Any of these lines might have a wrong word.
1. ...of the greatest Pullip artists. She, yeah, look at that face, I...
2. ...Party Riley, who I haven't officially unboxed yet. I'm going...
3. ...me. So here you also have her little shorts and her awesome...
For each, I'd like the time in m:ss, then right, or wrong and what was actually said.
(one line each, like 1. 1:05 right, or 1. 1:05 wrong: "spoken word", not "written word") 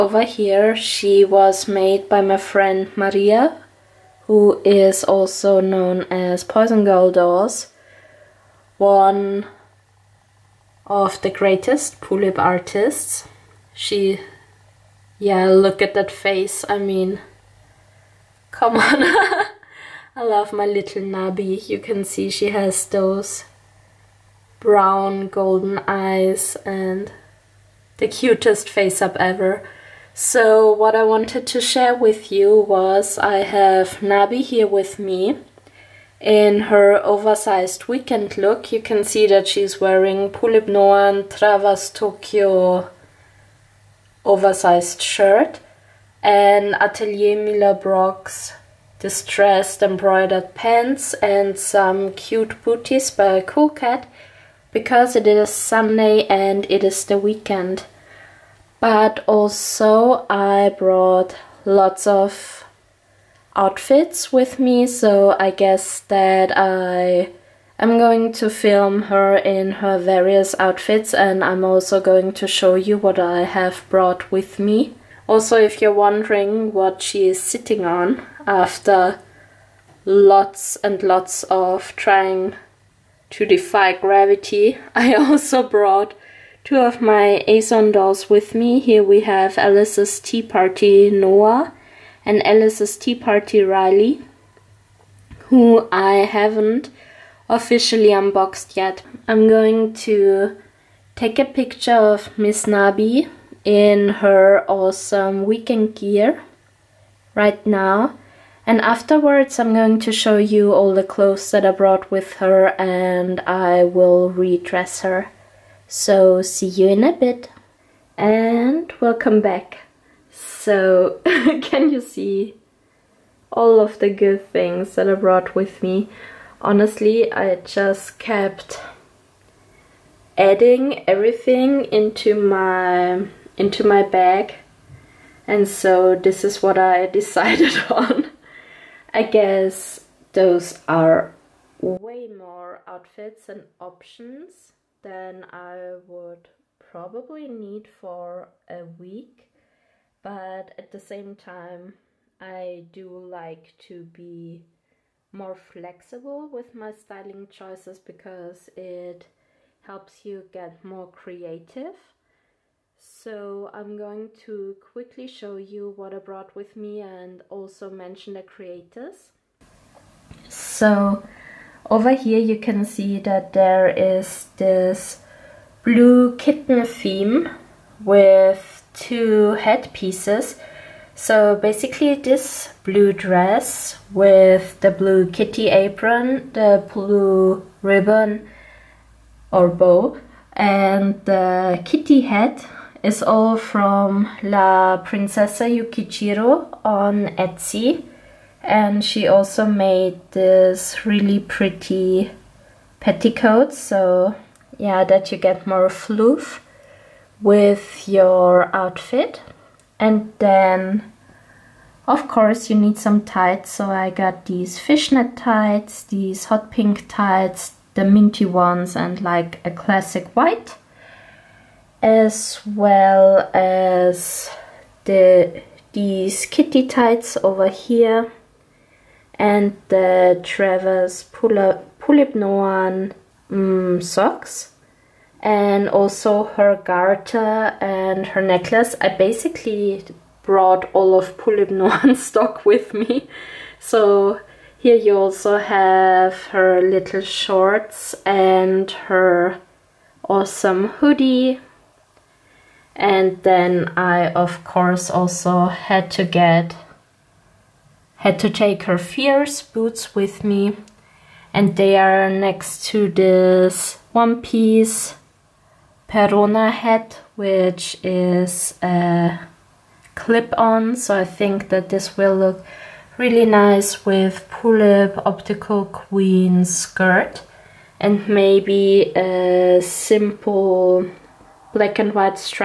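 1. 0:10 right
2. 1:33 right
3. 4:02 right.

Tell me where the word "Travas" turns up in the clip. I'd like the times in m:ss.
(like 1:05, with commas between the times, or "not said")
0:41, 3:50.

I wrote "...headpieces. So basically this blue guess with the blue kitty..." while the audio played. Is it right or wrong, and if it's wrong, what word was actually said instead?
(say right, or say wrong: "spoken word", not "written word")
wrong: "dress", not "guess".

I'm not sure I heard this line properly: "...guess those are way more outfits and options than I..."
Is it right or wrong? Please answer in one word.
right.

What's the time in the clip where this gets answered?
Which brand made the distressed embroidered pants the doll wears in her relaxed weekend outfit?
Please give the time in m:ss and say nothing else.
0:46.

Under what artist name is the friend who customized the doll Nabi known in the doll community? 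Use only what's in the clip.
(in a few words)
Poison Girl Dolls.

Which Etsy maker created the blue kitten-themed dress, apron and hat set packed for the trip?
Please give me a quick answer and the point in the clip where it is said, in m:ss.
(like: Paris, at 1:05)
La Princesa Yukichiro, at 3:14.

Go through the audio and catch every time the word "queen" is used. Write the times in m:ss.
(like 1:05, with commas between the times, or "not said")
4:35.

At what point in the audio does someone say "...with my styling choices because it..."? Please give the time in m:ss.
2:36.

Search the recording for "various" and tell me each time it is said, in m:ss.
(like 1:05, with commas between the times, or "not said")
1:09.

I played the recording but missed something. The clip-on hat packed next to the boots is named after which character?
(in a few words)
Perona.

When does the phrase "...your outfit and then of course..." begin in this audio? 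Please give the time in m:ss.
3:28.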